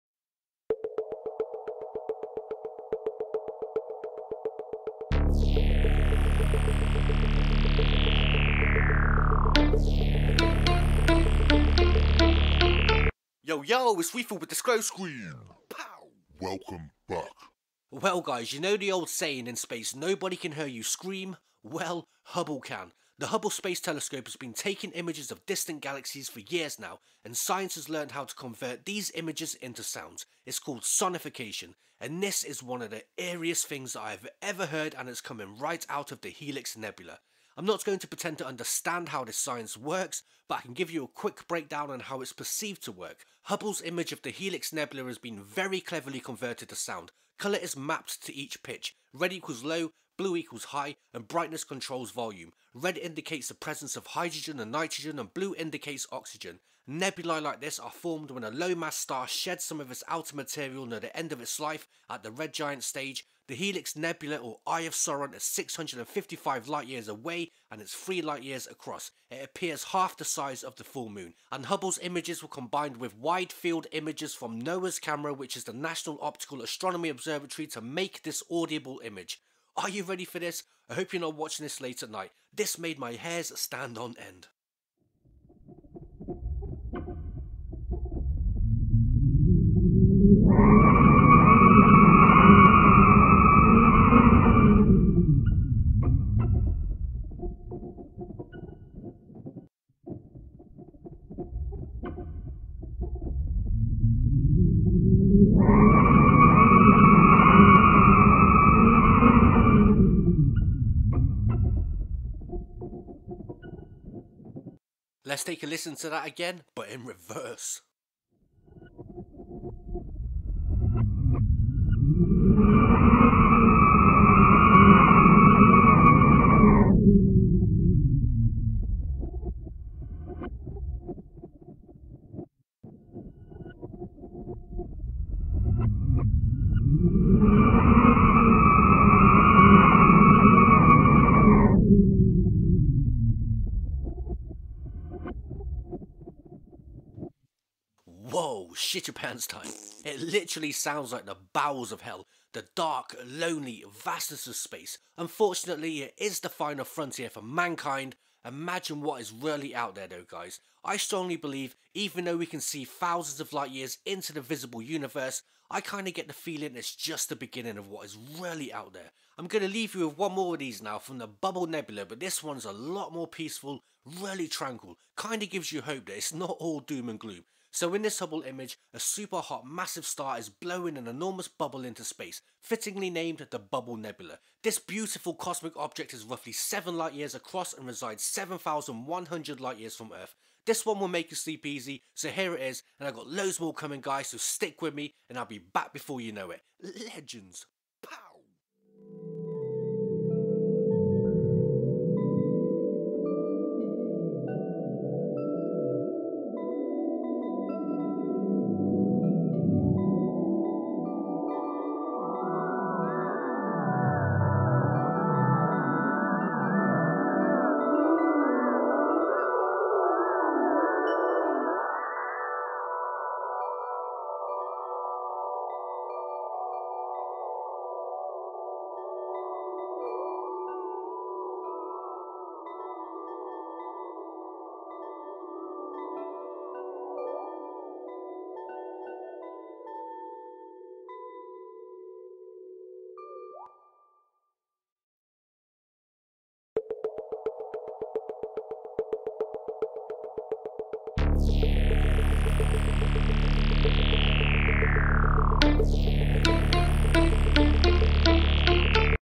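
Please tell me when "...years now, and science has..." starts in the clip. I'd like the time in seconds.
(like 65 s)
26 s.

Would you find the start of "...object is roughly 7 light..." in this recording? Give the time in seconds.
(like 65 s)
185 s.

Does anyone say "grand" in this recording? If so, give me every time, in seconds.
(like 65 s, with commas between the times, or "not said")
not said.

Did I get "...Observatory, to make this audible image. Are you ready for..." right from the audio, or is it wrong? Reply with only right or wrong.
right.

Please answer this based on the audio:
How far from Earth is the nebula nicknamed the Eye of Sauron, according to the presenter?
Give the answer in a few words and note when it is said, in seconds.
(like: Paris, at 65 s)
655 light years, at 65 s.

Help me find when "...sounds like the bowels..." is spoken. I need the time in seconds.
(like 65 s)
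150 s.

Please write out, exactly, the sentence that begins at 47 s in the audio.
Colour is mapped to each pitch, Red equals low, blue equals high, and brightness controls volume.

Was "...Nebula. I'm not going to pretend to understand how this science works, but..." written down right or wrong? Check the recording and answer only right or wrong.
right.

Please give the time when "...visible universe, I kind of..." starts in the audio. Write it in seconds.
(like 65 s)
164 s.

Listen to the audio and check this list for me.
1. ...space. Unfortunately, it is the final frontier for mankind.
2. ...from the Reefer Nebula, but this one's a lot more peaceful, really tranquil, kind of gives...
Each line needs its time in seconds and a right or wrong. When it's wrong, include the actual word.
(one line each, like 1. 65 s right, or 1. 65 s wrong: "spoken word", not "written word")
1. 154 s right
2. 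170 s wrong: "Bubble", not "Reefer".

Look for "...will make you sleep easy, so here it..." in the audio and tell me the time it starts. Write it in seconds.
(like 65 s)
190 s.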